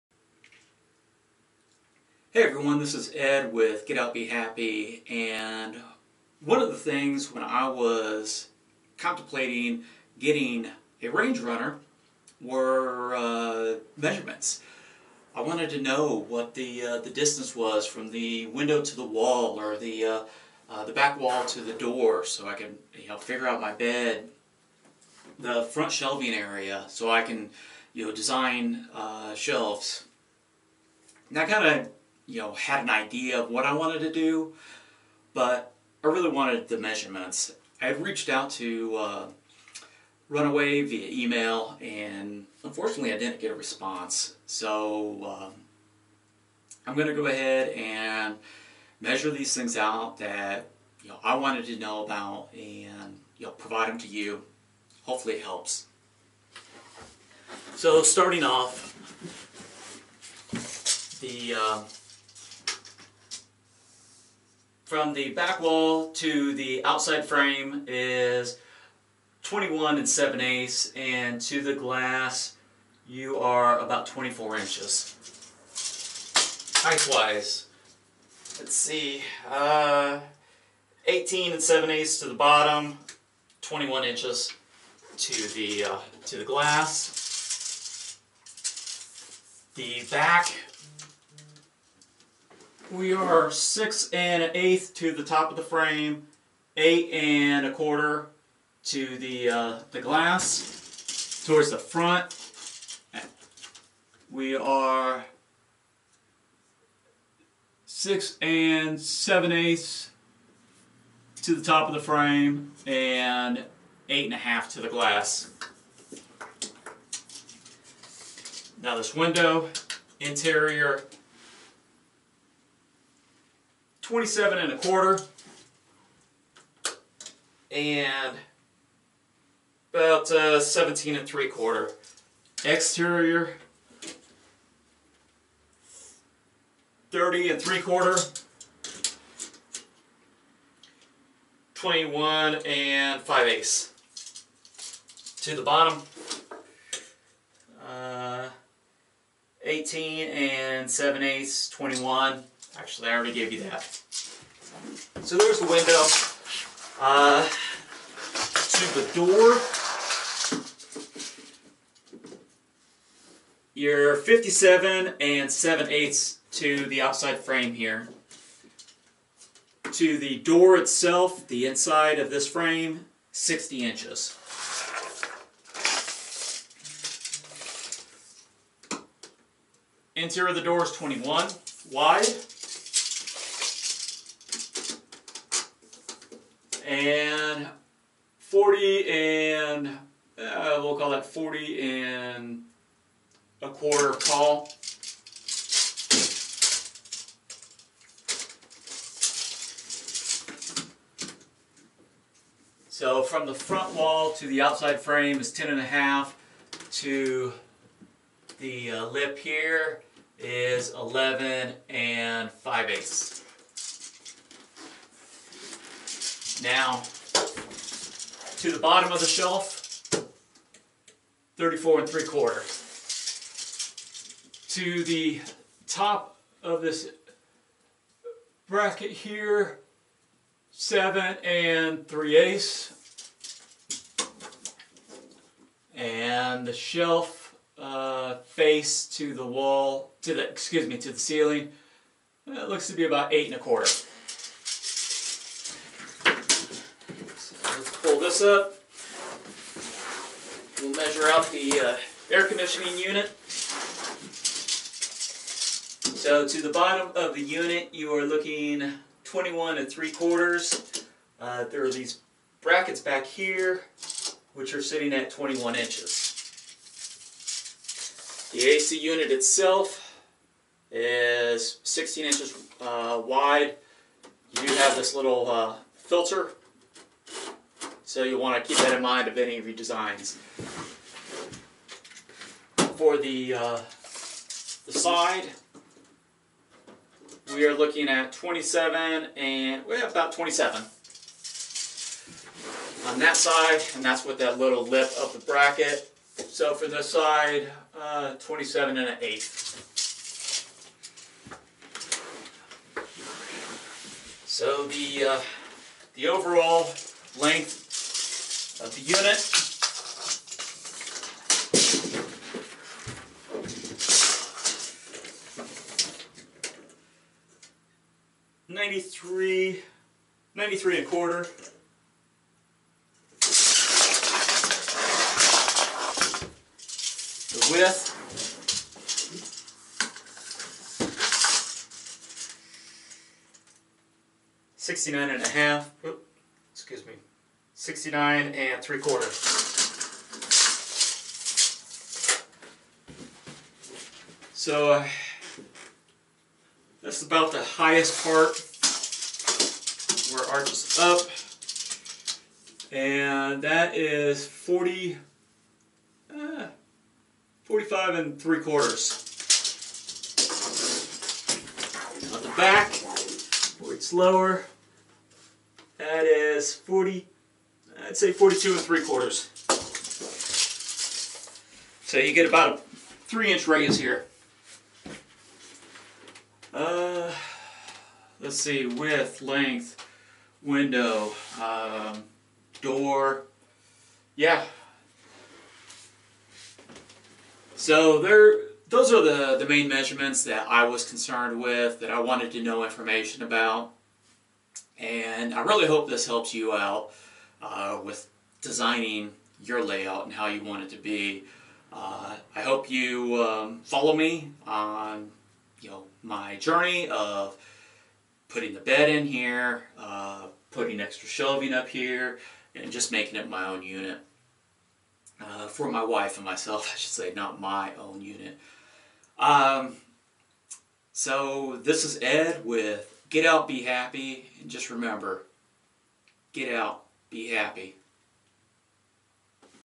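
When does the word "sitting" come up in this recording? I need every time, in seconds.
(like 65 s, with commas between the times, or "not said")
264 s.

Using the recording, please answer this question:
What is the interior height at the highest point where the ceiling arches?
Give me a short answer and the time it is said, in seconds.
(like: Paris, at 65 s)
45 3/4 inches, at 357 s.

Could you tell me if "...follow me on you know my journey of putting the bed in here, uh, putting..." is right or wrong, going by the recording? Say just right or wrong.
right.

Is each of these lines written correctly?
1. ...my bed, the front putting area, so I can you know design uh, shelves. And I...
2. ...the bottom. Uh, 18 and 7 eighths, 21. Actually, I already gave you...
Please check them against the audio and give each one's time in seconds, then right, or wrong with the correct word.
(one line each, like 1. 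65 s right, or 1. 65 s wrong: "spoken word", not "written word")
1. 23 s wrong: "shelving", not "putting"
2. 145 s right.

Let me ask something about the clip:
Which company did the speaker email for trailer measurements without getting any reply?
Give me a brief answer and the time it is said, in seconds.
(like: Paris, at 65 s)
Runaway, at 40 s.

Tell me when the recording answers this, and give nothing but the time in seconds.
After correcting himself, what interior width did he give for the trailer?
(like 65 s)
337 s.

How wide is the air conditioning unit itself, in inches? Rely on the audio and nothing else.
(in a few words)
16 inches.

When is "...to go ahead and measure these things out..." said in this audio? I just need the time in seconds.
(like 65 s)
47 s.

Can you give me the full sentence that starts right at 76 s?
Height-wise, let's see, uh, 18 and 7 eighths to the bottom, 21 inches to the, uh, to the glass.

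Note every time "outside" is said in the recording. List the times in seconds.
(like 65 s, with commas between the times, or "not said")
66 s, 167 s, 204 s.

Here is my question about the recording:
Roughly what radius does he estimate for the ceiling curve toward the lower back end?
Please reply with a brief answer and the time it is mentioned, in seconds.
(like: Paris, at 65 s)
3 inches, at 373 s.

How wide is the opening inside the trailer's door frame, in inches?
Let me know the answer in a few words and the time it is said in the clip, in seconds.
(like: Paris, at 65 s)
21, at 180 s.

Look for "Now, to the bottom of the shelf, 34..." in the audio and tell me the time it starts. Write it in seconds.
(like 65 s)
216 s.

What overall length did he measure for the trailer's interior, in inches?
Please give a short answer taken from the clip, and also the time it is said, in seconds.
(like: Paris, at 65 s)
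93 1/4, at 320 s.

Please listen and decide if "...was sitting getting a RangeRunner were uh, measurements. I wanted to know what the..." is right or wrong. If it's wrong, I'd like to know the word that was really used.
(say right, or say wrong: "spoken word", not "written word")
wrong: "contemplating", not "sitting".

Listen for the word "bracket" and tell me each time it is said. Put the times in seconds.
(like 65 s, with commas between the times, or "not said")
228 s, 262 s, 295 s.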